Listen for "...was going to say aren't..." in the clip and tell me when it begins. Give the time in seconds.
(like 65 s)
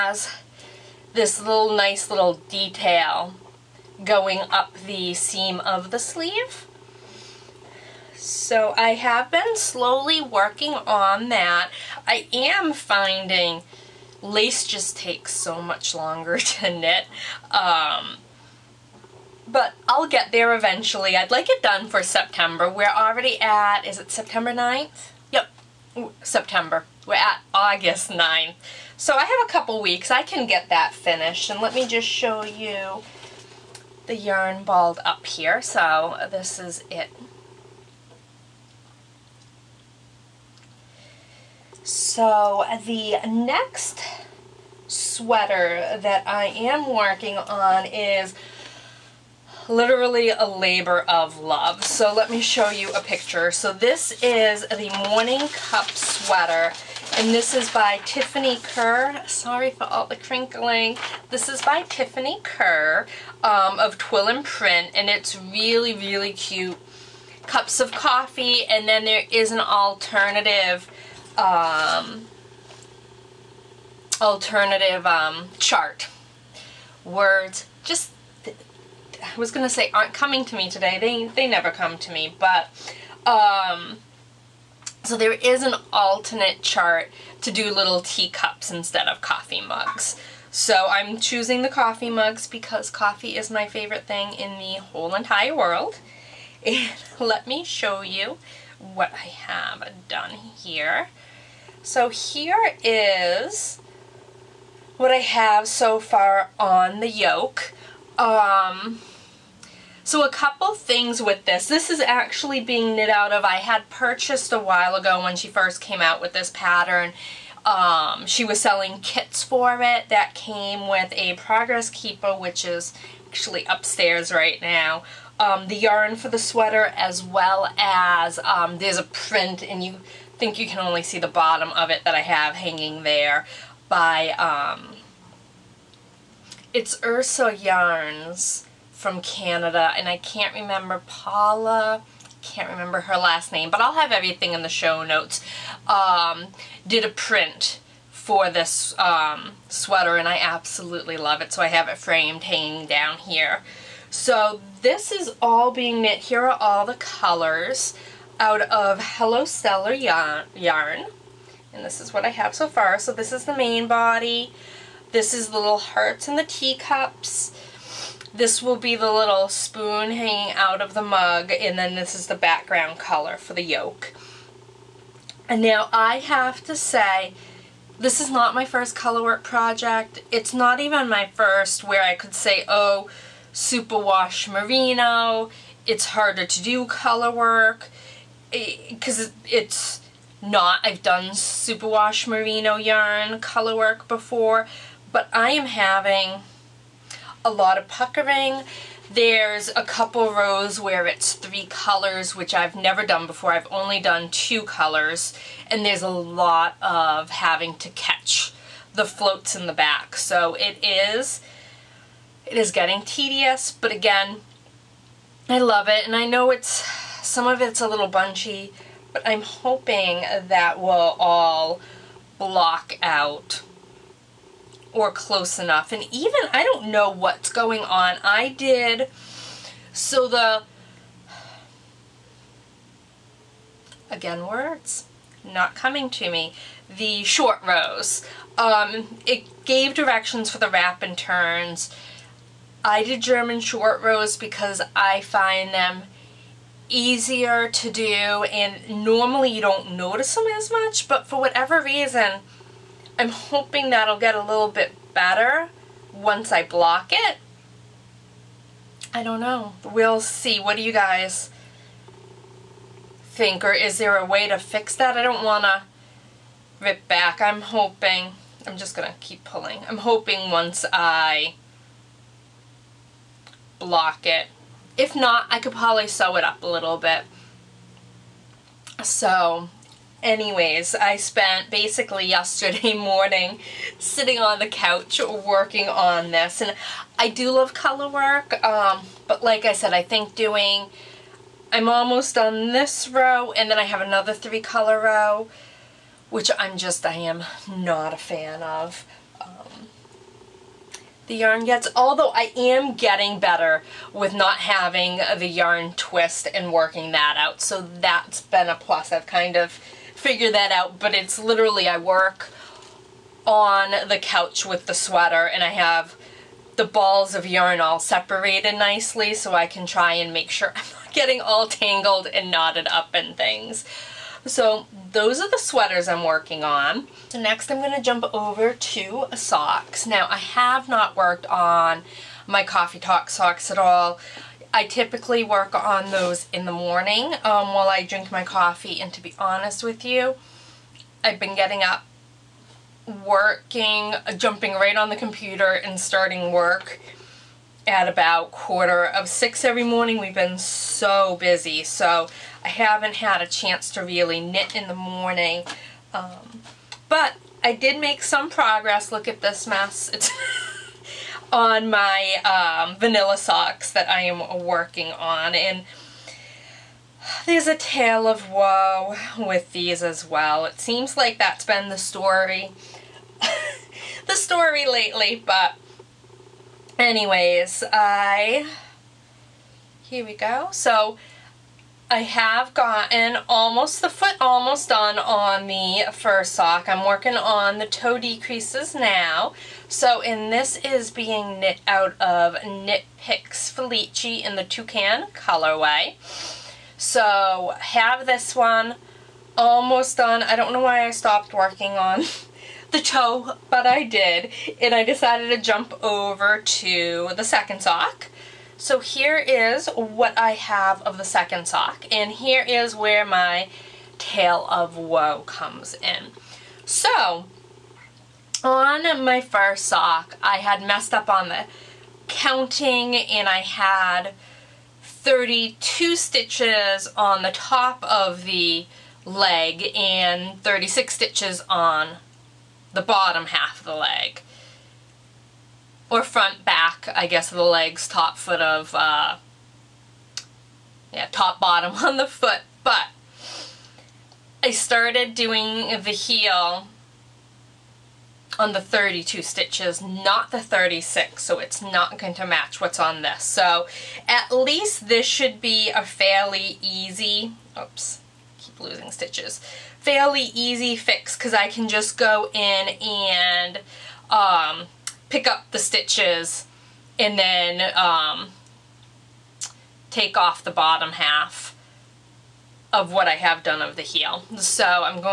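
79 s.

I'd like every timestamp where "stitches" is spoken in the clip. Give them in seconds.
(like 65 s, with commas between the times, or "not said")
426 s, 431 s, 449 s, 459 s, 465 s.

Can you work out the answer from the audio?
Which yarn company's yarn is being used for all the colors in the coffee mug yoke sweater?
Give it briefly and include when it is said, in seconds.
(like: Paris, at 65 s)
Hello Stella, at 159 s.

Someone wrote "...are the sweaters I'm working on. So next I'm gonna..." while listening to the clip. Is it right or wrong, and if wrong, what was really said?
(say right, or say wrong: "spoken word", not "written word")
right.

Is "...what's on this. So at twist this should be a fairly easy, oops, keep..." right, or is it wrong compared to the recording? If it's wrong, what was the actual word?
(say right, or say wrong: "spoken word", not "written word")
wrong: "least", not "twist".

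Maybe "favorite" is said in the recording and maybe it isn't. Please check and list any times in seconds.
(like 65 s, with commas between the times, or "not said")
93 s.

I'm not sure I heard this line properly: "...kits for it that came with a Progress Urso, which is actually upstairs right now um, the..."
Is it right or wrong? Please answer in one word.
wrong.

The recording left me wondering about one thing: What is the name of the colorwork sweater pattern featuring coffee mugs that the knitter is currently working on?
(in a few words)
Morning Cup.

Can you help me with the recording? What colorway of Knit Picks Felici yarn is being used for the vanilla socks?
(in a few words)
Toucan.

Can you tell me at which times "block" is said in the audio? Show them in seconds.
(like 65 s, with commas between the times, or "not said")
222 s, 256 s, 273 s.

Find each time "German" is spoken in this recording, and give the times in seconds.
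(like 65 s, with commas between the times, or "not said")
243 s.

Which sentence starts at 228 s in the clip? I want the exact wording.
I did, so the, again, words not coming to me, the short rows.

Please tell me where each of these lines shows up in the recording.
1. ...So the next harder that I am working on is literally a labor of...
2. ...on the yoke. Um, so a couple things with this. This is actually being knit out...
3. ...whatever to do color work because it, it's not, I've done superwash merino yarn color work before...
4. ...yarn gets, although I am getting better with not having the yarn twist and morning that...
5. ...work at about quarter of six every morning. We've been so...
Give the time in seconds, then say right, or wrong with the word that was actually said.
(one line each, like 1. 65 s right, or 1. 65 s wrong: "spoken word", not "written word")
1. 41 s wrong: "sweater", not "harder"
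2. 106 s right
3. 186 s wrong: "harder", not "whatever"
4. 301 s wrong: "working", not "morning"
5. 346 s right.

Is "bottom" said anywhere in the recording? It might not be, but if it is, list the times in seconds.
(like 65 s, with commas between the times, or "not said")
131 s, 433 s, 441 s, 470 s.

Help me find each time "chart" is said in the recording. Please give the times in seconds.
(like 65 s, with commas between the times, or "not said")
75 s, 86 s.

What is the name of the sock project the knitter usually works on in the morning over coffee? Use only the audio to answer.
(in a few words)
Coffee Talk.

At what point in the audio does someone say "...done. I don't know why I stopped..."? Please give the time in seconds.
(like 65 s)
400 s.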